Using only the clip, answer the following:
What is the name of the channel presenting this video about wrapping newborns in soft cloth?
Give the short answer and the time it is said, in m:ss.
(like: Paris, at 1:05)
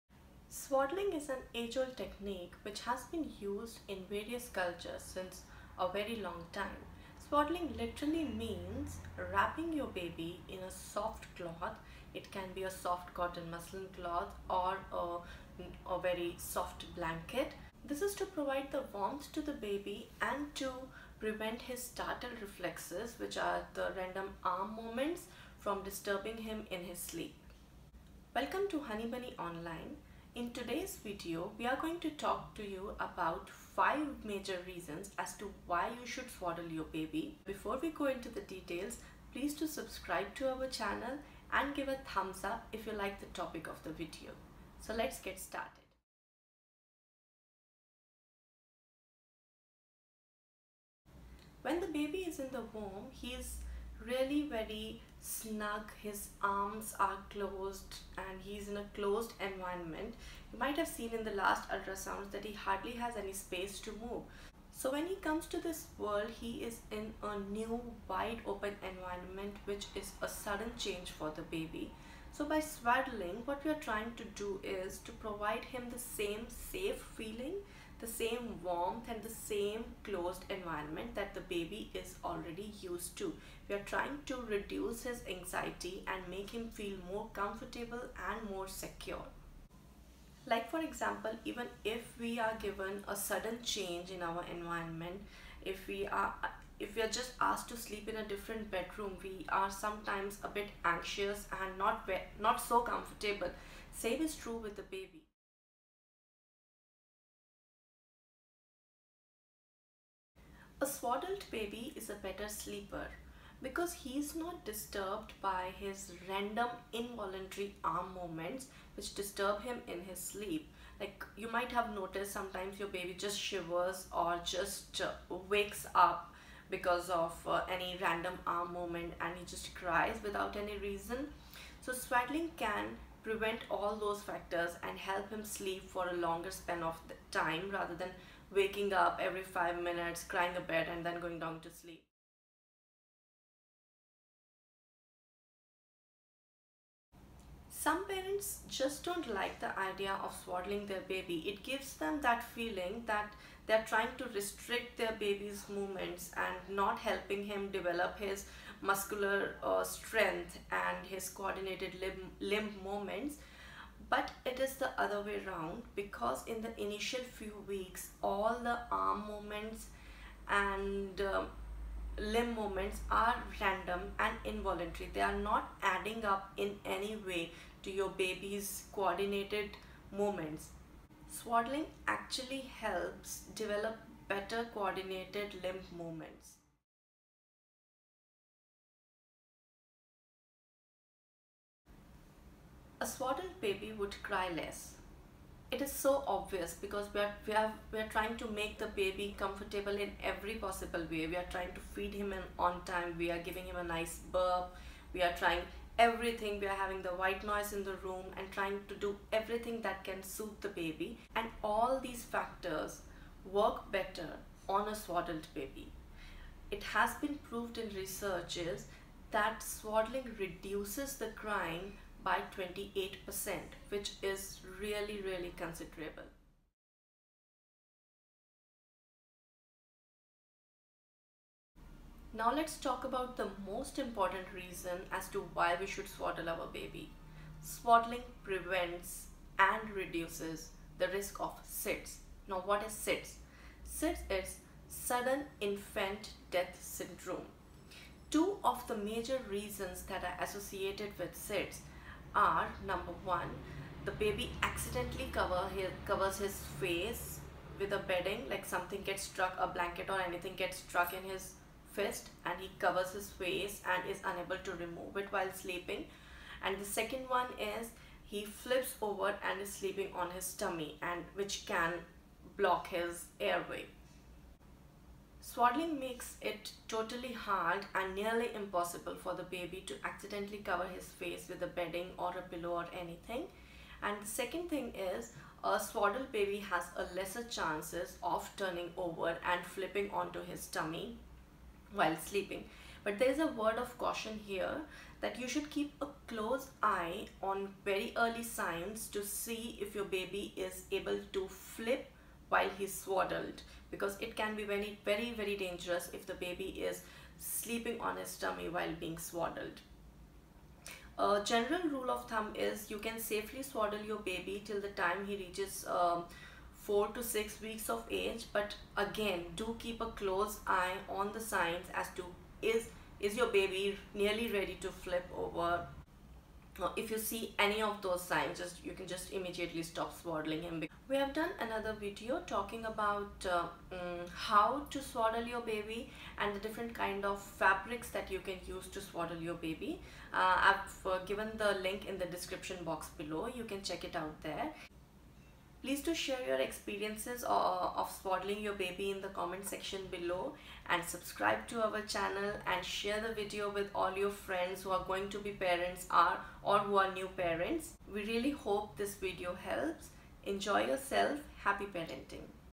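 Honey Bunny Online, at 0:28.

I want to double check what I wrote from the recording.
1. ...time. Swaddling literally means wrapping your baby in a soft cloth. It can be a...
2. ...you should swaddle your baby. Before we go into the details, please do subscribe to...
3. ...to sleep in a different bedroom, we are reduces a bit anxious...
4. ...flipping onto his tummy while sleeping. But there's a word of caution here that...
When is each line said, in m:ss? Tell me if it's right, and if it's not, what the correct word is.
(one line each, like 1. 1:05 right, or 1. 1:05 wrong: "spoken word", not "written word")
1. 0:06 right
2. 0:35 right
3. 1:37 wrong: "sometimes", not "reduces"
4. 4:49 right.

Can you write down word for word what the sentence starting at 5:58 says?
We really hope this video helps.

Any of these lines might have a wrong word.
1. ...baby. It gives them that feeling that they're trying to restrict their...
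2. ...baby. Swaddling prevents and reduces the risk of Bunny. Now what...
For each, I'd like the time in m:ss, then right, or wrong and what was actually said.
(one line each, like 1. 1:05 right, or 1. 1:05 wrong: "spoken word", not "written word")
1. 2:31 right
2. 3:56 wrong: "SIDS", not "Bunny".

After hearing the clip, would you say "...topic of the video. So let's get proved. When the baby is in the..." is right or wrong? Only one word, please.
wrong.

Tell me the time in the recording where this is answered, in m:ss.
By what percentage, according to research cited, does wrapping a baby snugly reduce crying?
3:42.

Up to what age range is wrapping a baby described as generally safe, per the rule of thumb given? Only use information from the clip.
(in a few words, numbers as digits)
4 to 6 weeks.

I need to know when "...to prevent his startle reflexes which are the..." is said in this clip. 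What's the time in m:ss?
0:20.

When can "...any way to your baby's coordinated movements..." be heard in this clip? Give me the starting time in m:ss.
2:56.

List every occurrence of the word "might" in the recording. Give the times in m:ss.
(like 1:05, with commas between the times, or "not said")
1:00, 2:01.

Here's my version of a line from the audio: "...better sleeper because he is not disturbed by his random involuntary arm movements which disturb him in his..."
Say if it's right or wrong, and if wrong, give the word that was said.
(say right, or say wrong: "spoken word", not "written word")
right.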